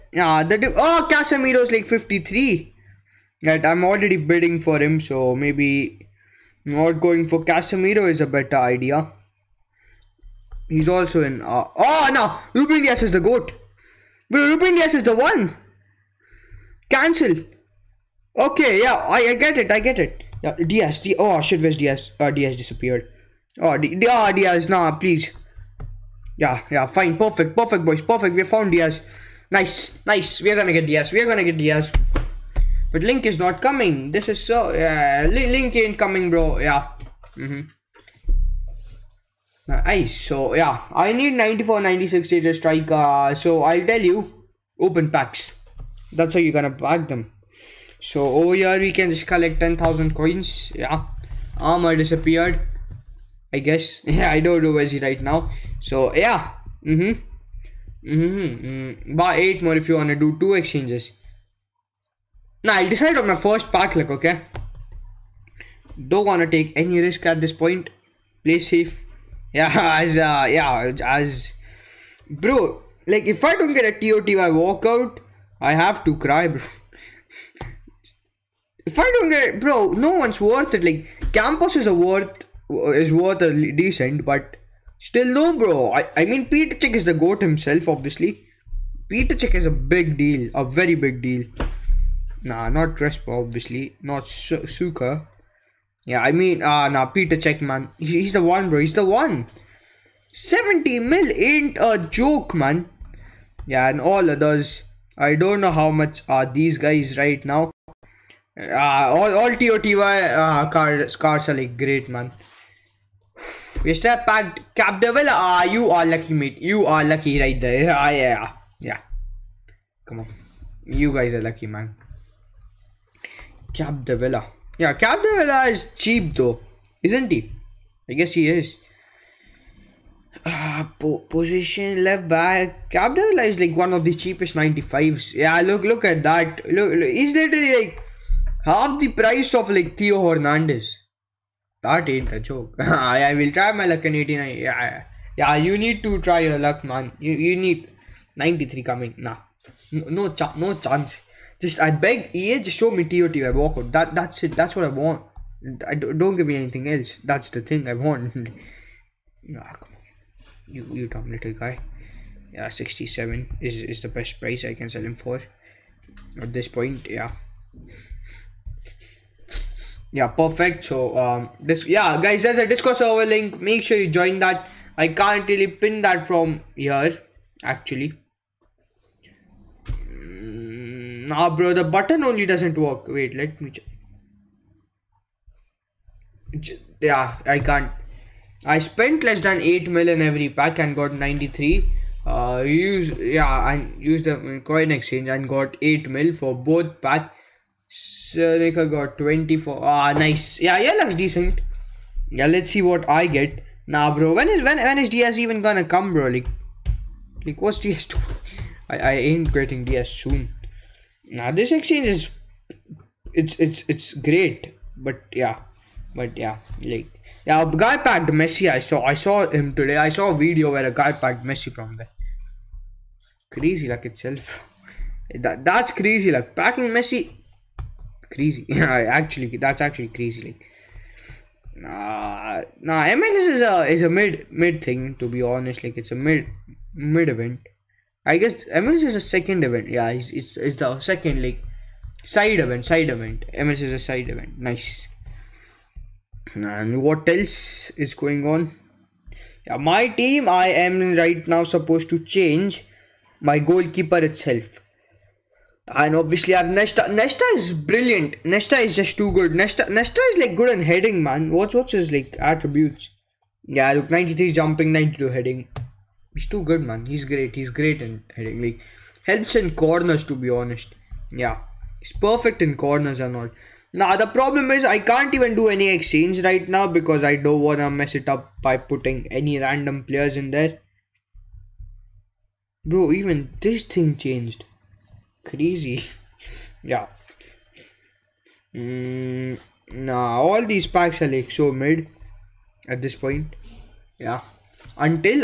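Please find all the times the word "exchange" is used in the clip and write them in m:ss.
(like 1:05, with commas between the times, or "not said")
1:00, 3:14, 3:31, 4:35.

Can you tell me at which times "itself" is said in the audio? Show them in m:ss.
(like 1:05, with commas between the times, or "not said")
3:44, 4:14.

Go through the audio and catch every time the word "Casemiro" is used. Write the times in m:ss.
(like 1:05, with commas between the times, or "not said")
0:01, 0:07.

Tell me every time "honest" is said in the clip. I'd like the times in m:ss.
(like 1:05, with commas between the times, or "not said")
3:55, 4:30.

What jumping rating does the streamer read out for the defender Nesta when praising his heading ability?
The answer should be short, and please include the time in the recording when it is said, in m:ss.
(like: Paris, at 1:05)
93, at 4:24.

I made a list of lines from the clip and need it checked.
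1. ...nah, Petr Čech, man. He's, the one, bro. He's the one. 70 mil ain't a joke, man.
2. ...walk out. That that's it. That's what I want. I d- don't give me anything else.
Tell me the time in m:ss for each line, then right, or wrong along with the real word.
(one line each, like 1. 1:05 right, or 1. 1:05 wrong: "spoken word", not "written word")
1. 1:36 right
2. 2:33 right.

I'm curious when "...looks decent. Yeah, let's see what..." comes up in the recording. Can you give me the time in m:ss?
3:21.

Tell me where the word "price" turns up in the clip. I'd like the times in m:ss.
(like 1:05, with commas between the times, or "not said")
2:19, 2:44.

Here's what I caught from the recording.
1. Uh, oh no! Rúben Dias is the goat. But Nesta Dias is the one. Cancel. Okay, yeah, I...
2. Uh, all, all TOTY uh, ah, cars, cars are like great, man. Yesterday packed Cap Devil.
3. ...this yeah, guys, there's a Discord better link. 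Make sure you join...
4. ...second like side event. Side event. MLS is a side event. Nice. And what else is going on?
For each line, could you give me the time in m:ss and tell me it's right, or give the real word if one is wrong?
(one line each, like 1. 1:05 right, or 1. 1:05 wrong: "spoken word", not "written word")
1. 0:11 wrong: "Rúben", not "Nesta"
2. 1:48 right
3. 2:51 wrong: "server", not "better"
4. 4:00 right.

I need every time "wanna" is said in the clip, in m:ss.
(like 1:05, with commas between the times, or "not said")
0:59, 1:06, 4:37.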